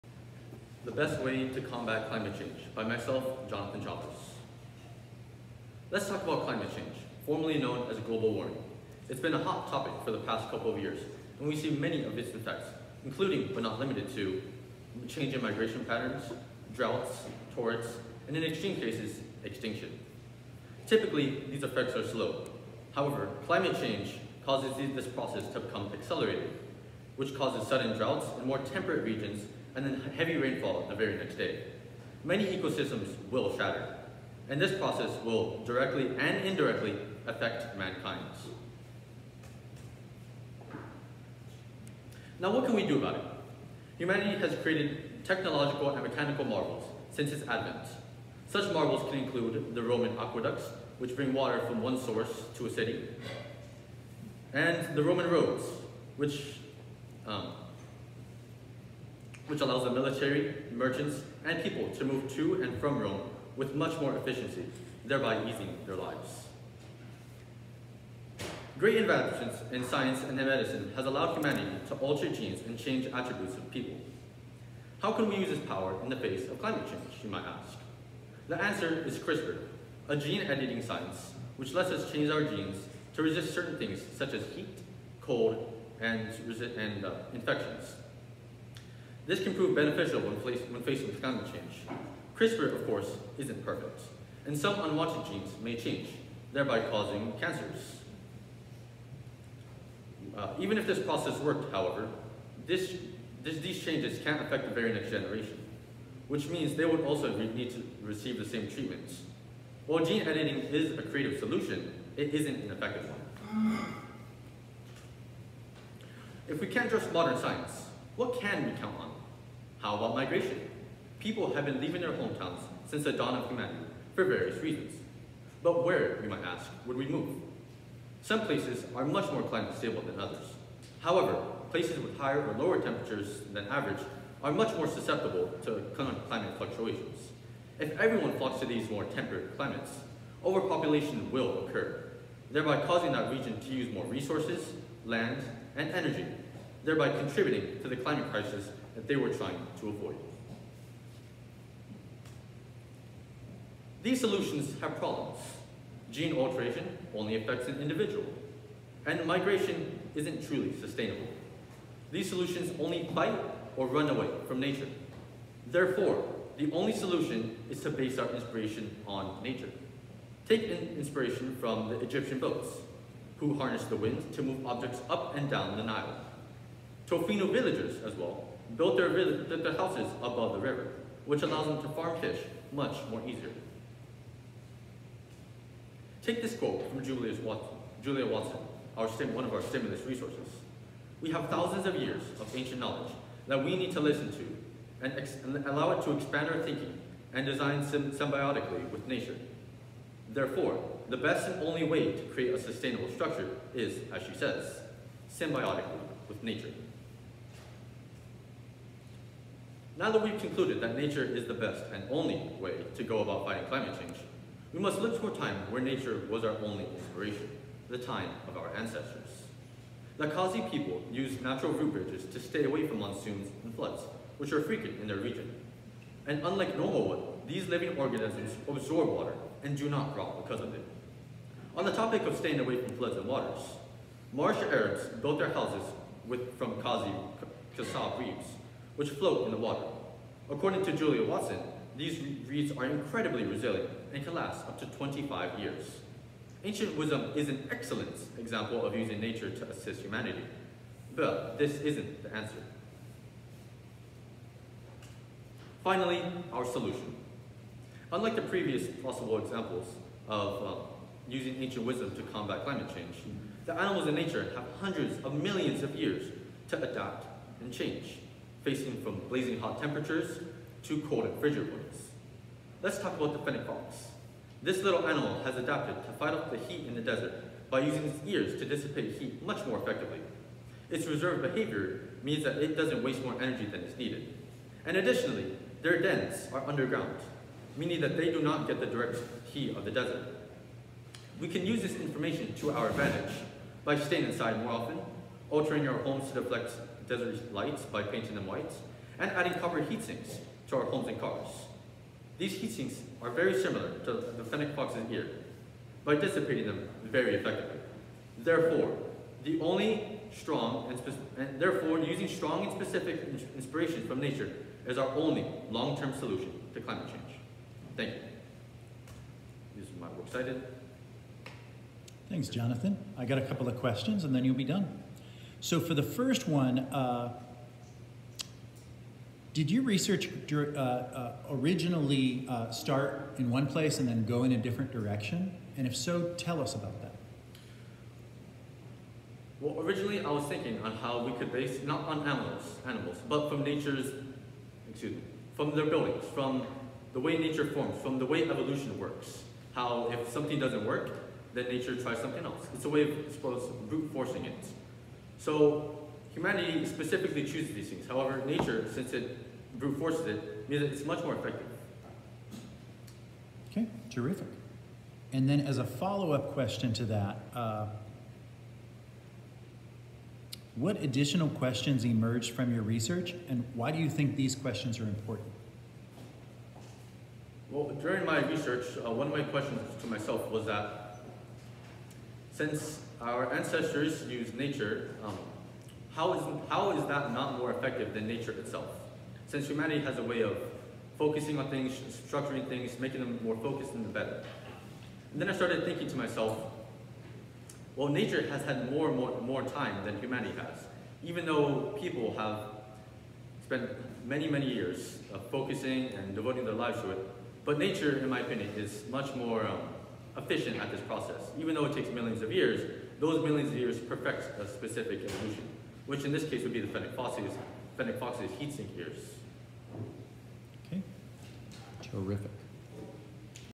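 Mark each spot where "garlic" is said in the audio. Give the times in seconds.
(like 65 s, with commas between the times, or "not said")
not said.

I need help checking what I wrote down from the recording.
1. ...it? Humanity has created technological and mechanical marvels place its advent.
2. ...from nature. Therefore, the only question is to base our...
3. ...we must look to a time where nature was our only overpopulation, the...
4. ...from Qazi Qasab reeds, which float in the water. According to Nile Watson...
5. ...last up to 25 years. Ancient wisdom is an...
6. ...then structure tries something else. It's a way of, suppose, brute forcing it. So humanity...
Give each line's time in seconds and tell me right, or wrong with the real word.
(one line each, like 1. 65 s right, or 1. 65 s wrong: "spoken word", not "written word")
1. 43 s wrong: "since", not "place"
2. 164 s wrong: "solution", not "question"
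3. 214 s wrong: "inspiration", not "overpopulation"
4. 236 s wrong: "Julia", not "Nile"
5. 244 s right
6. 351 s wrong: "nature", not "structure".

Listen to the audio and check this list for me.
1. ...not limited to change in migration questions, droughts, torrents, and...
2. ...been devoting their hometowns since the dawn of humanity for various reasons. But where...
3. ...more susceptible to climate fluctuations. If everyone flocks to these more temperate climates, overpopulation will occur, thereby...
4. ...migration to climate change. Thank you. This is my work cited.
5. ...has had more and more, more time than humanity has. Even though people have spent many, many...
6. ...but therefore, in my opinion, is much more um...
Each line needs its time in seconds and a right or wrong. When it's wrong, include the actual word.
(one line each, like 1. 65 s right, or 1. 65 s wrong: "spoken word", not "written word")
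1. 13 s wrong: "patterns", not "questions"
2. 121 s wrong: "leaving", not "devoting"
3. 134 s right
4. 316 s wrong: "solution", not "migration"
5. 398 s right
6. 407 s wrong: "nature", not "therefore".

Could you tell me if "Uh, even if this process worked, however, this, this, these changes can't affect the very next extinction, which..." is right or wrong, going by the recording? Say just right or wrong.
wrong.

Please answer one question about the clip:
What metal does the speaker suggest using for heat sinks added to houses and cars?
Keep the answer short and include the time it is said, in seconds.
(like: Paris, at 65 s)
copper, at 299 s.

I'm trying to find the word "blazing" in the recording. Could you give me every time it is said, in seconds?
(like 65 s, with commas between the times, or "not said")
269 s.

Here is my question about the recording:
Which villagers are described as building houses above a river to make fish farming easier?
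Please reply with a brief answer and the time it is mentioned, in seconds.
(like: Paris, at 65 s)
Tofino, at 177 s.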